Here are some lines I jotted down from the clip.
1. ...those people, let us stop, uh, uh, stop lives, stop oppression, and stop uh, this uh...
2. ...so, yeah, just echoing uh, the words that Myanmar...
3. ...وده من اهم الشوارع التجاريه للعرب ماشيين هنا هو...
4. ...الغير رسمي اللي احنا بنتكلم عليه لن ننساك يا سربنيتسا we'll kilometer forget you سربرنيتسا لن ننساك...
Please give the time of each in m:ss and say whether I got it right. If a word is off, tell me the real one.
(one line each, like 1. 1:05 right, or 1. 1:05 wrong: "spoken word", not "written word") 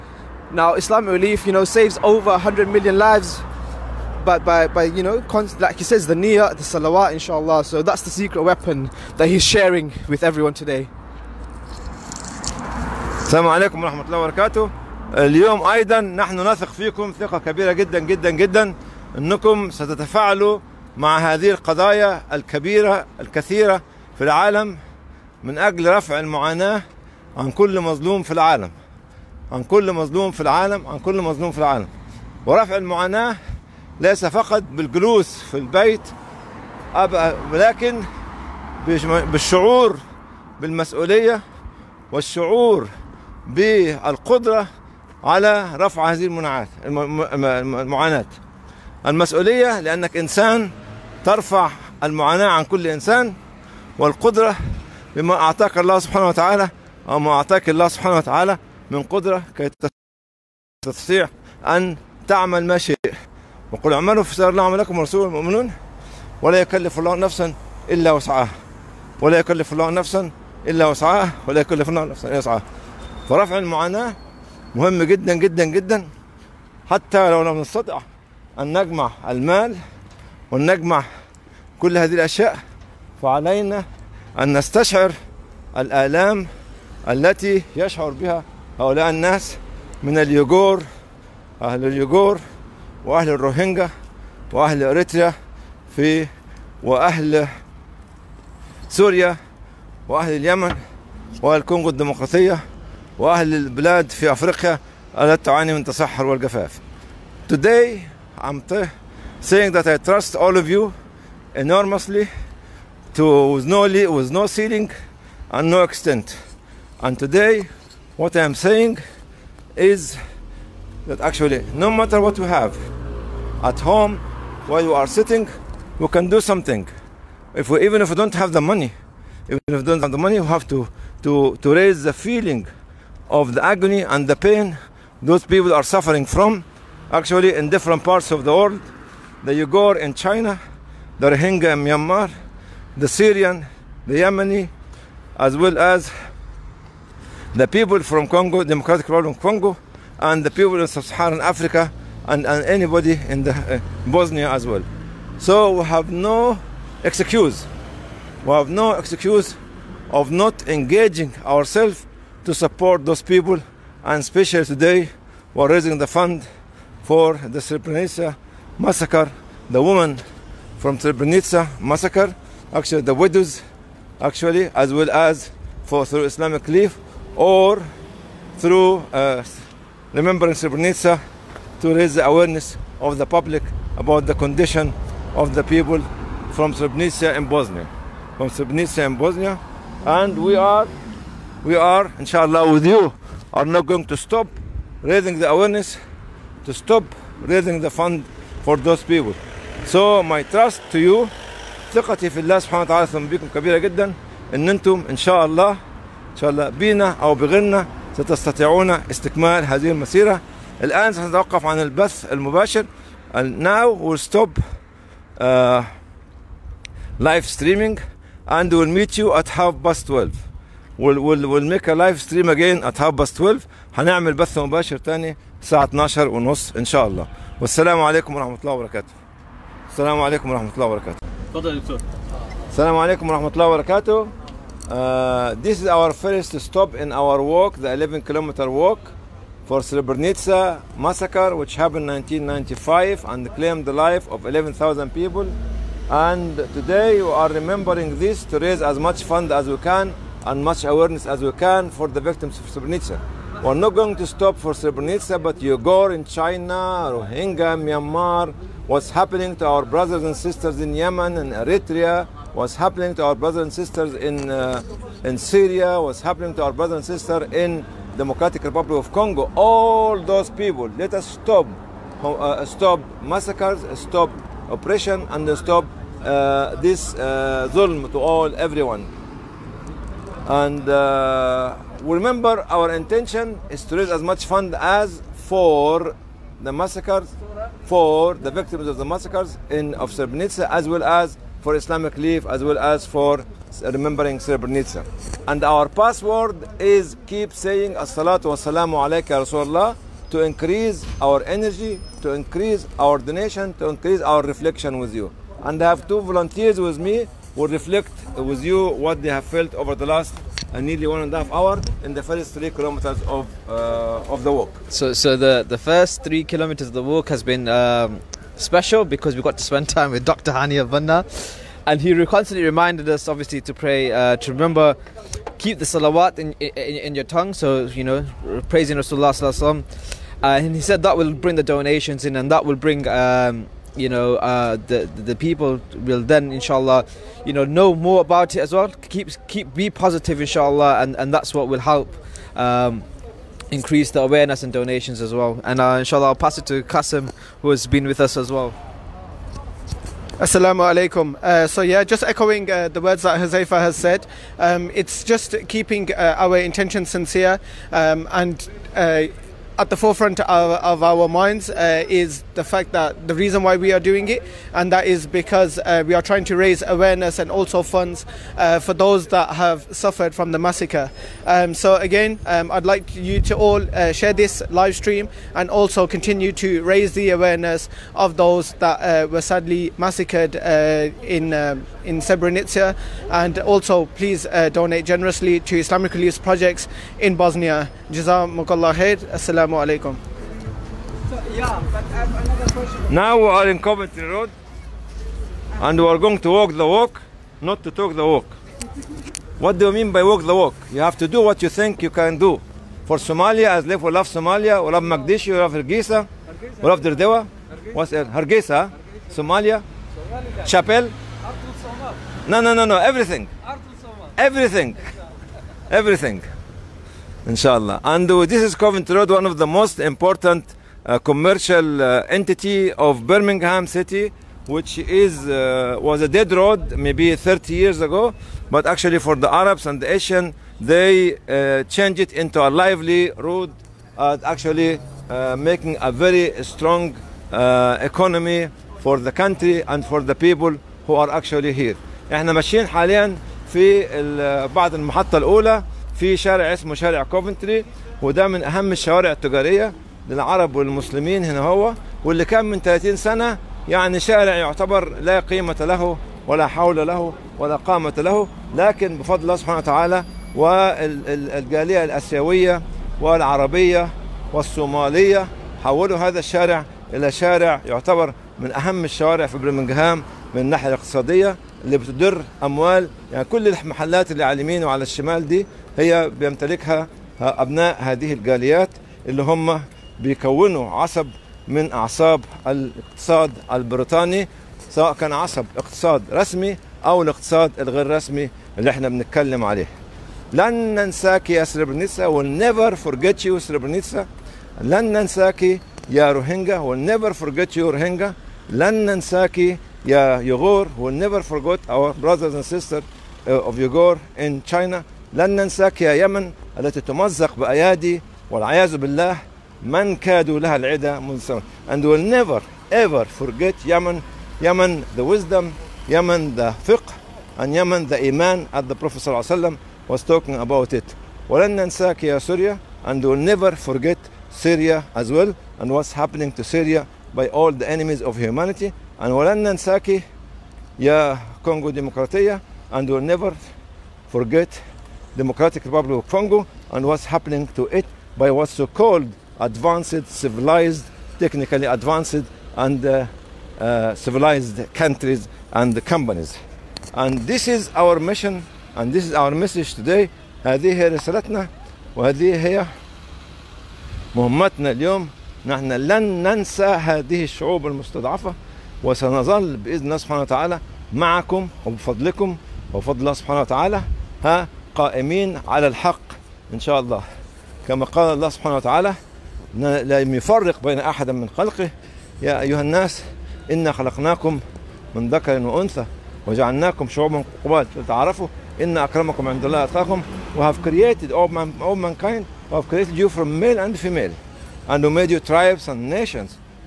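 1. 4:30 wrong: "massacres", not "lives"
2. 5:51 wrong: "Huzaifa", not "Myanmar"
3. 7:28 wrong: "والمسلمين", not "ماشيين"
4. 8:07 wrong: "never", not "kilometer".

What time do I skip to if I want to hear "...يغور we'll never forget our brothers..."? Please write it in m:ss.
8:20.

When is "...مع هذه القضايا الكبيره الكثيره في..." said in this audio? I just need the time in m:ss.
0:20.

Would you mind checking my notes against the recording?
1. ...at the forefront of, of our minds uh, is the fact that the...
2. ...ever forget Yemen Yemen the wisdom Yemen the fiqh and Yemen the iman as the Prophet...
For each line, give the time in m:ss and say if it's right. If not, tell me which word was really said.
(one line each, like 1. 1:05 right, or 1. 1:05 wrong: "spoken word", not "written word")
1. 5:59 right
2. 8:32 right.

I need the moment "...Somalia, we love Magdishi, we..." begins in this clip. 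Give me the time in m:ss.
6:44.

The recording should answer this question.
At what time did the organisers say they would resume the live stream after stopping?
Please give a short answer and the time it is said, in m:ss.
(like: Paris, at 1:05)
half past 12, at 3:39.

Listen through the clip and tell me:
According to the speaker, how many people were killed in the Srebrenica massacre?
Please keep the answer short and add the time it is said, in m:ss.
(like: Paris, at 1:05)
11,000, at 4:04.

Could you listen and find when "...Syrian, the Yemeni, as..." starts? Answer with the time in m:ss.
2:23.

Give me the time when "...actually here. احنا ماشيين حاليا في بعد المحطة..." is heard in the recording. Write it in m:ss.
7:21.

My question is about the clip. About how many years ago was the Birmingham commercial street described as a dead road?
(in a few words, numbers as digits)
30 years.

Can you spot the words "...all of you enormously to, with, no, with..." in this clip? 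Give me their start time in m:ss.
1:50.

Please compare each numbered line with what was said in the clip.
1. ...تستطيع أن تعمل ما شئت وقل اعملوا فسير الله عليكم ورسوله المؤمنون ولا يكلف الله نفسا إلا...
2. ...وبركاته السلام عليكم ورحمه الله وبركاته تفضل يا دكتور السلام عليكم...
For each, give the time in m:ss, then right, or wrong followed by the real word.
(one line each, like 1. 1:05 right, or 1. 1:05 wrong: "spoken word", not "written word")
1. 1:00 wrong: "عملكم", not "عليكم"
2. 3:48 right.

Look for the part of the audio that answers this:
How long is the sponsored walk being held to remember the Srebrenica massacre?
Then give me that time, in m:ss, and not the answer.
3:57.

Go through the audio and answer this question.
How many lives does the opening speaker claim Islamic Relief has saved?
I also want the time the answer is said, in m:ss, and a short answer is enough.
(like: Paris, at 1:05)
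over 100 million, at 0:02.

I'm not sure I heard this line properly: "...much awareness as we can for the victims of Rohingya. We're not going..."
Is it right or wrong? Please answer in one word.
wrong.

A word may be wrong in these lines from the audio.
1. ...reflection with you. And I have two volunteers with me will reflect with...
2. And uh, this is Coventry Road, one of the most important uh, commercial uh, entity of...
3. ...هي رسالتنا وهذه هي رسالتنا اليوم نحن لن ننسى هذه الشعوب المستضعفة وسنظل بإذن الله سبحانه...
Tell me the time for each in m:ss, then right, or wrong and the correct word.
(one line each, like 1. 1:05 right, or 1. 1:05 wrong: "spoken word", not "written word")
1. 5:04 right
2. 6:58 right
3. 9:10 wrong: "مهمتنا", not "رسالتنا".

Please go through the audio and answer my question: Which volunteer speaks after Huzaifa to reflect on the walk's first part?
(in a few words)
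Qasim.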